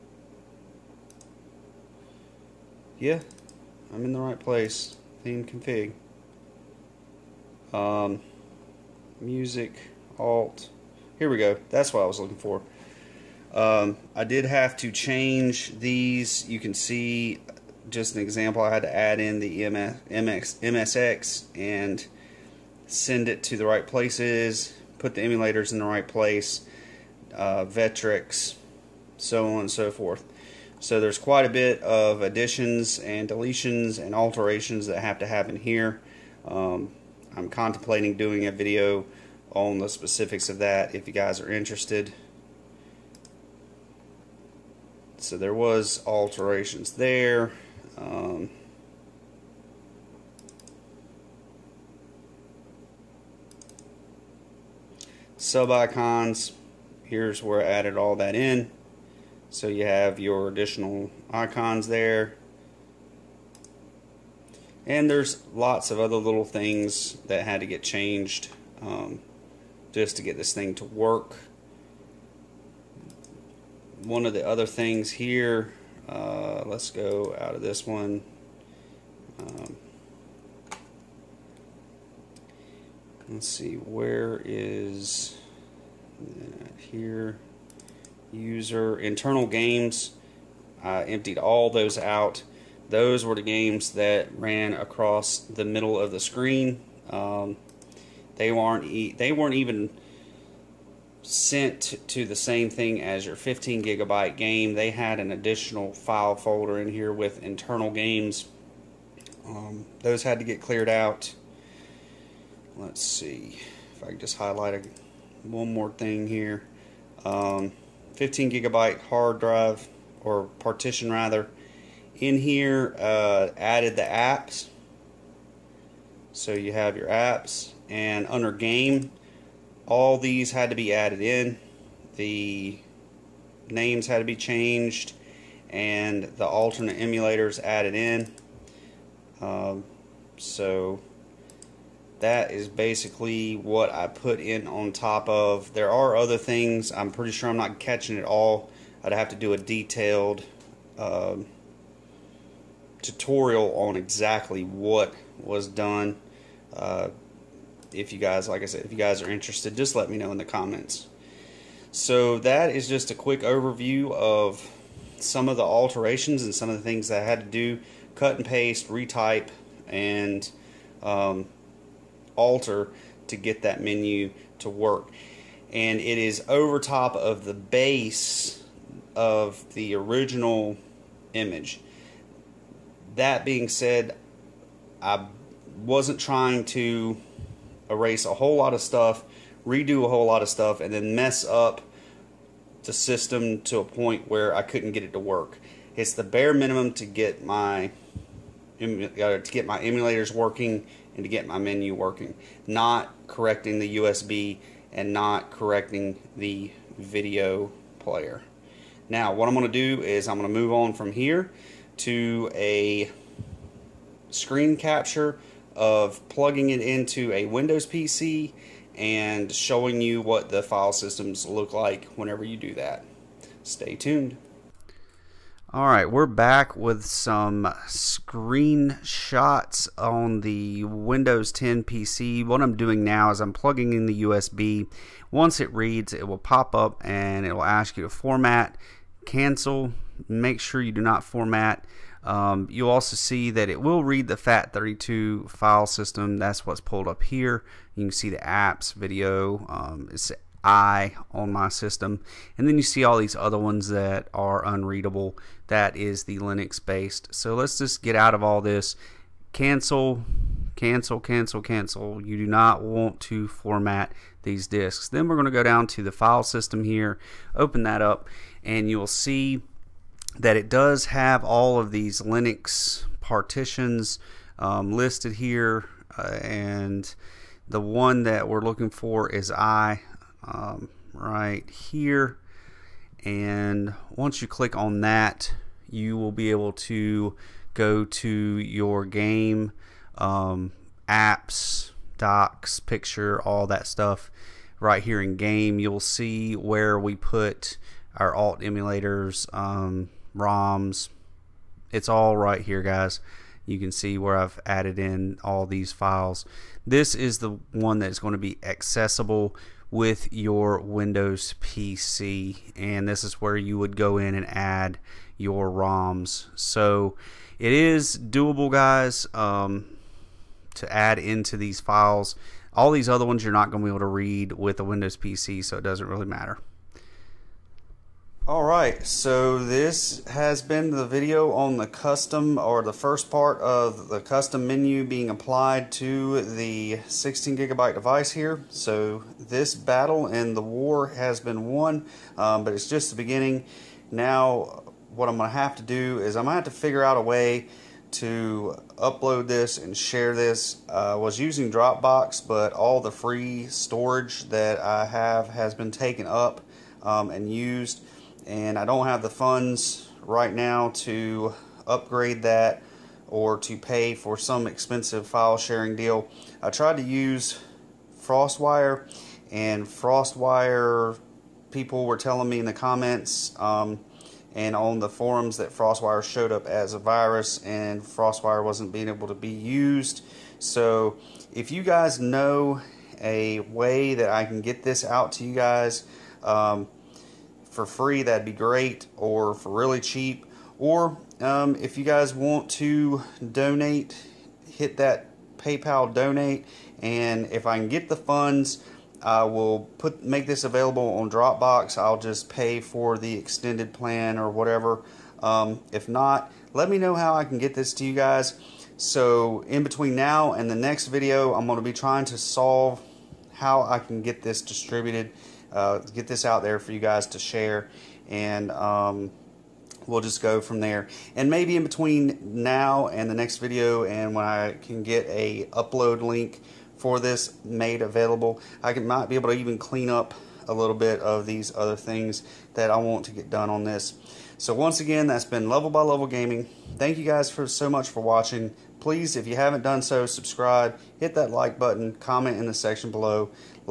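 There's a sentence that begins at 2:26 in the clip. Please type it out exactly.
I'm pretty sure I'm not catching it all.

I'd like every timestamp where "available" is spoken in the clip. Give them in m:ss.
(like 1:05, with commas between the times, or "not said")
6:40, 7:08.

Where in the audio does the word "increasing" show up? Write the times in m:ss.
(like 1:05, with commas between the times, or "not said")
not said.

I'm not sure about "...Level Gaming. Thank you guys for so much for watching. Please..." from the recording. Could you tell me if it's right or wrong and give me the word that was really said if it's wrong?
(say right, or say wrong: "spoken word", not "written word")
right.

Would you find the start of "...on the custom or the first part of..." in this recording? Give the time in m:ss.
5:31.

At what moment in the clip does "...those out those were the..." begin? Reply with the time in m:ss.
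1:31.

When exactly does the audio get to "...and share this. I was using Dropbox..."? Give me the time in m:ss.
5:49.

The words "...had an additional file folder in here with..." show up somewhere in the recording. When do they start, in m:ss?
1:44.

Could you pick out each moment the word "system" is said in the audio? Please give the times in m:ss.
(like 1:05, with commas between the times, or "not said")
3:12, 3:40, 4:05, 4:11, 4:26.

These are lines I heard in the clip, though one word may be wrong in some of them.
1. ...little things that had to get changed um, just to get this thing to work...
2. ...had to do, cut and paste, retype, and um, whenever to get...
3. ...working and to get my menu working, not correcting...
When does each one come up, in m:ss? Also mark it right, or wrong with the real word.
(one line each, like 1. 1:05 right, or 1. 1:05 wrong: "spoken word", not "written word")
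1. 1:06 right
2. 2:47 wrong: "alter", not "whenever"
3. 3:20 right.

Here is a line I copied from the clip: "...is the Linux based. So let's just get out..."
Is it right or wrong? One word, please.
right.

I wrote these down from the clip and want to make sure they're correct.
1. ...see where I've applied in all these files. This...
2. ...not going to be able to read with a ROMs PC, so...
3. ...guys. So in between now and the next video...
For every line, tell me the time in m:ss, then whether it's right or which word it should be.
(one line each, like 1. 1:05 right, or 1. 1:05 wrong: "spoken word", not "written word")
1. 5:03 wrong: "added", not "applied"
2. 5:23 wrong: "Windows", not "ROMs"
3. 6:48 right.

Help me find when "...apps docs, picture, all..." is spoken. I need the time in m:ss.
4:51.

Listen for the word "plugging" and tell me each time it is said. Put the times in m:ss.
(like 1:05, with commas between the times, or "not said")
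3:36, 3:53.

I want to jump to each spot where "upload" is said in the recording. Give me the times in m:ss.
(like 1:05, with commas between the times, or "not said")
5:48, 7:05.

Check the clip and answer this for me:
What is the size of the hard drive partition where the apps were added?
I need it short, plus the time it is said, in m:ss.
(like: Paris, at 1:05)
15 gigabyte, at 1:58.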